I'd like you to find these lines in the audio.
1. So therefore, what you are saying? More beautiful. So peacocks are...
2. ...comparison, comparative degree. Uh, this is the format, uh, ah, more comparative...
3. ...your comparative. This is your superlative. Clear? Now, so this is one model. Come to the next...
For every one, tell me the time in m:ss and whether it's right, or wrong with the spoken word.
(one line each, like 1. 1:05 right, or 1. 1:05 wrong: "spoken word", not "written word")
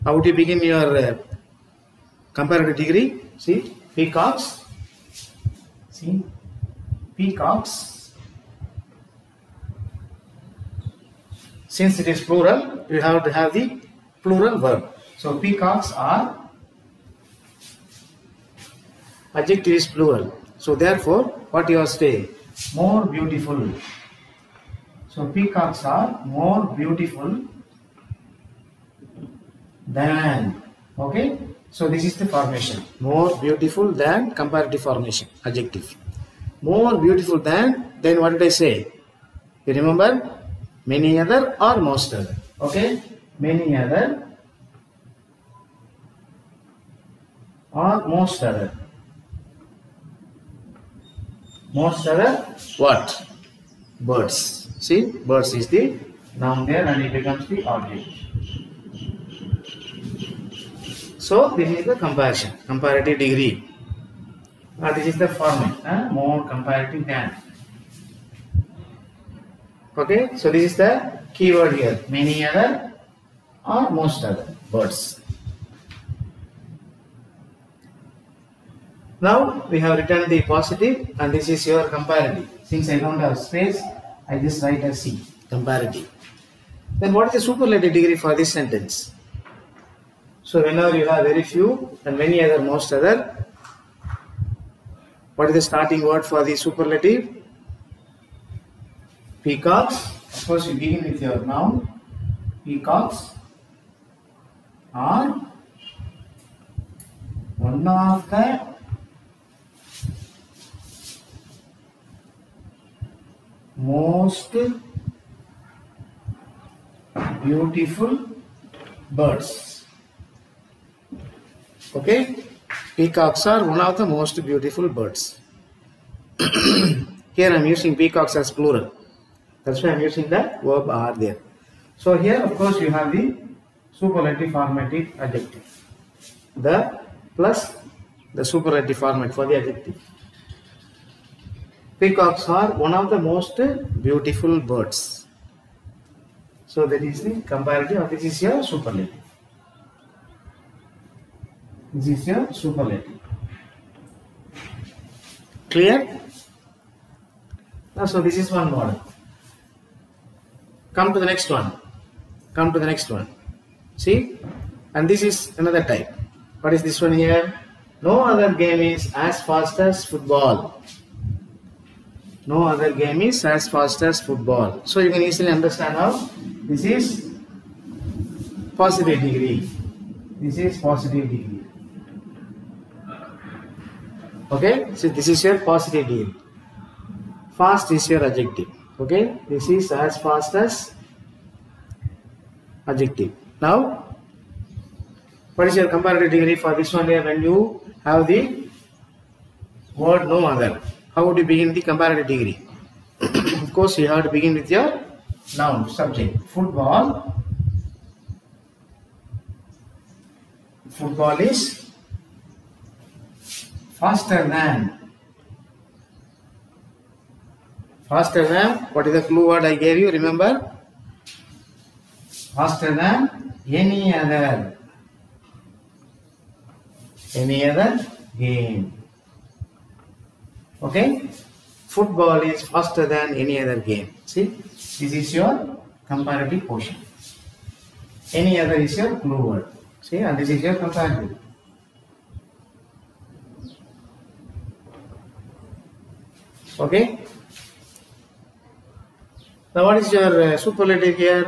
1. 0:20 right
2. 1:01 right
3. 2:28 wrong: "superlative", not "comparative".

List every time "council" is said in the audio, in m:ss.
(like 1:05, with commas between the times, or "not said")
not said.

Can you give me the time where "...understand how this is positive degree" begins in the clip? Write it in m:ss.
2:55.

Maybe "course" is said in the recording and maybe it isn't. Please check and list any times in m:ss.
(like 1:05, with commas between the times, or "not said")
1:40, 2:12, 3:23.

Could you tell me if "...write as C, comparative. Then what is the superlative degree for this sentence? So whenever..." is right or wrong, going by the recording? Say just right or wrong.
right.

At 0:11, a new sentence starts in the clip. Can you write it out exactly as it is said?
Since it is plural, you have to have the plural verb.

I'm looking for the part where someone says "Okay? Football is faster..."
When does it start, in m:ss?
3:50.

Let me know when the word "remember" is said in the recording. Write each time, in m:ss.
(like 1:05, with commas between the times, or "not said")
0:39, 3:40.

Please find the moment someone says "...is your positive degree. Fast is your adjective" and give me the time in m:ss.
3:05.